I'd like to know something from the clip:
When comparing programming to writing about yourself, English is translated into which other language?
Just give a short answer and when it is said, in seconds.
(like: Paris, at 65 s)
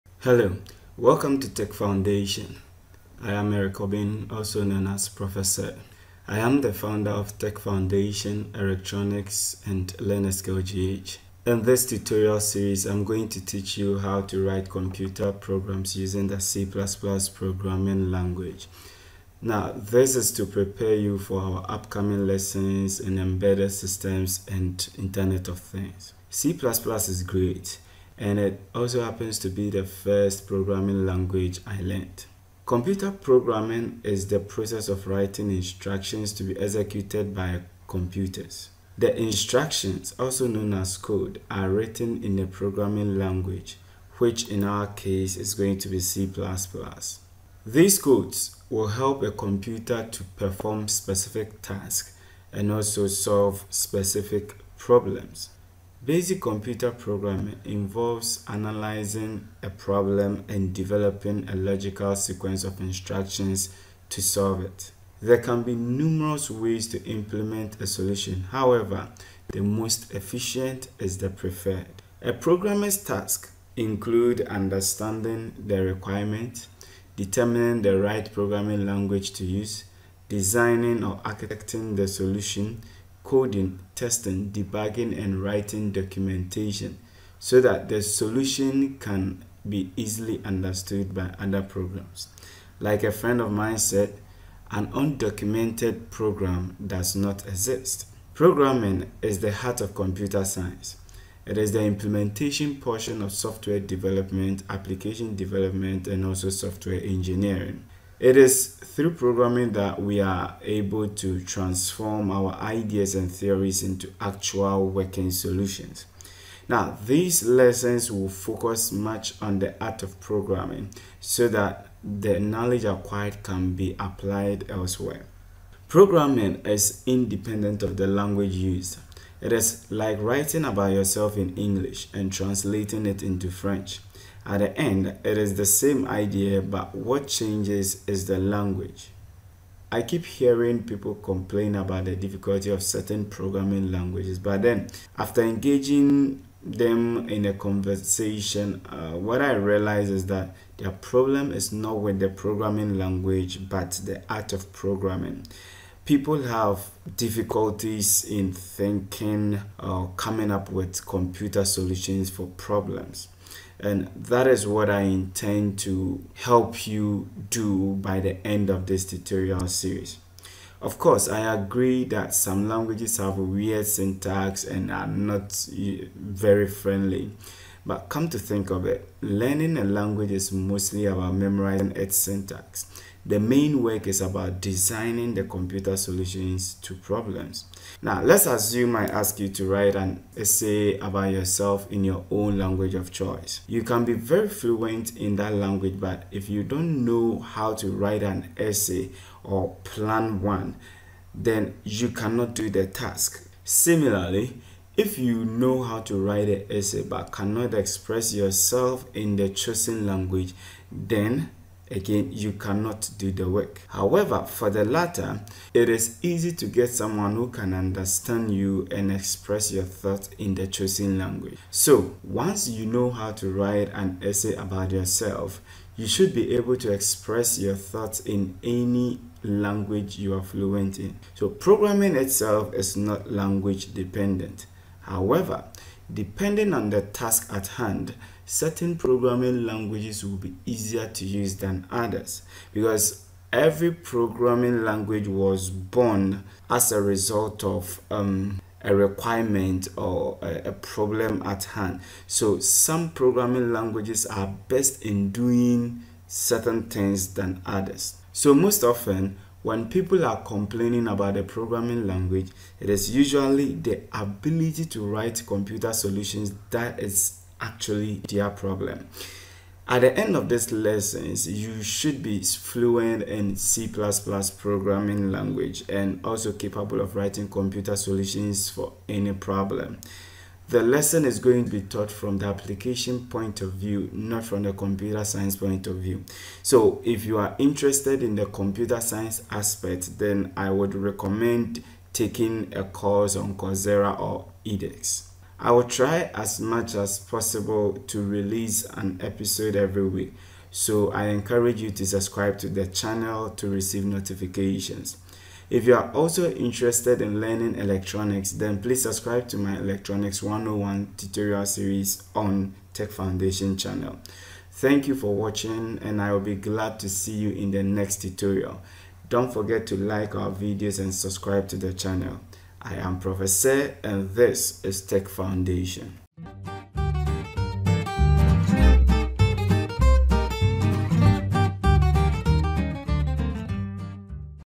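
French, at 133 s.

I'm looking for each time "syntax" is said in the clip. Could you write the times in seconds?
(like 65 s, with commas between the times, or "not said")
173 s, 182 s.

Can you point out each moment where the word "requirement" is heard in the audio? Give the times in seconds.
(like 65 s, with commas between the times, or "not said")
75 s, 248 s.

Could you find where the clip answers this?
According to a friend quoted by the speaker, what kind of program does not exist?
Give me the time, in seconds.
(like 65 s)
94 s.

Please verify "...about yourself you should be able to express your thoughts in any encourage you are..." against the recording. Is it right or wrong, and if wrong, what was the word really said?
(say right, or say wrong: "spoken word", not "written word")
wrong: "language", not "encourage".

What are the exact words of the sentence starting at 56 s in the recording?
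Basic computer programming involves analyzing a problem and developing a logical sequence of instructions to solve it.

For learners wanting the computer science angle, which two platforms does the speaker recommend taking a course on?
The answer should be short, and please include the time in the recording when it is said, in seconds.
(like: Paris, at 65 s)
Coursera or edX, at 293 s.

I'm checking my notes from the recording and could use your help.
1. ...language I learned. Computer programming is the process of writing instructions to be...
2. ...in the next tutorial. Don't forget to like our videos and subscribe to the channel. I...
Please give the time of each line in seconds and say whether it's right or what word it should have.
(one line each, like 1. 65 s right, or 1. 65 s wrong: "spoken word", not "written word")
1. 31 s right
2. 317 s right.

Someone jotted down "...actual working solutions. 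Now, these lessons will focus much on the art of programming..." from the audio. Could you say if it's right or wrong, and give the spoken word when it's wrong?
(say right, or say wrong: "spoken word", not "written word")
right.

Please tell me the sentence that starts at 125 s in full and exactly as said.
Programming is independent of the language used.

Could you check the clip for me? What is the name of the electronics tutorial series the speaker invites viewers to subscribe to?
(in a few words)
Electronics 101.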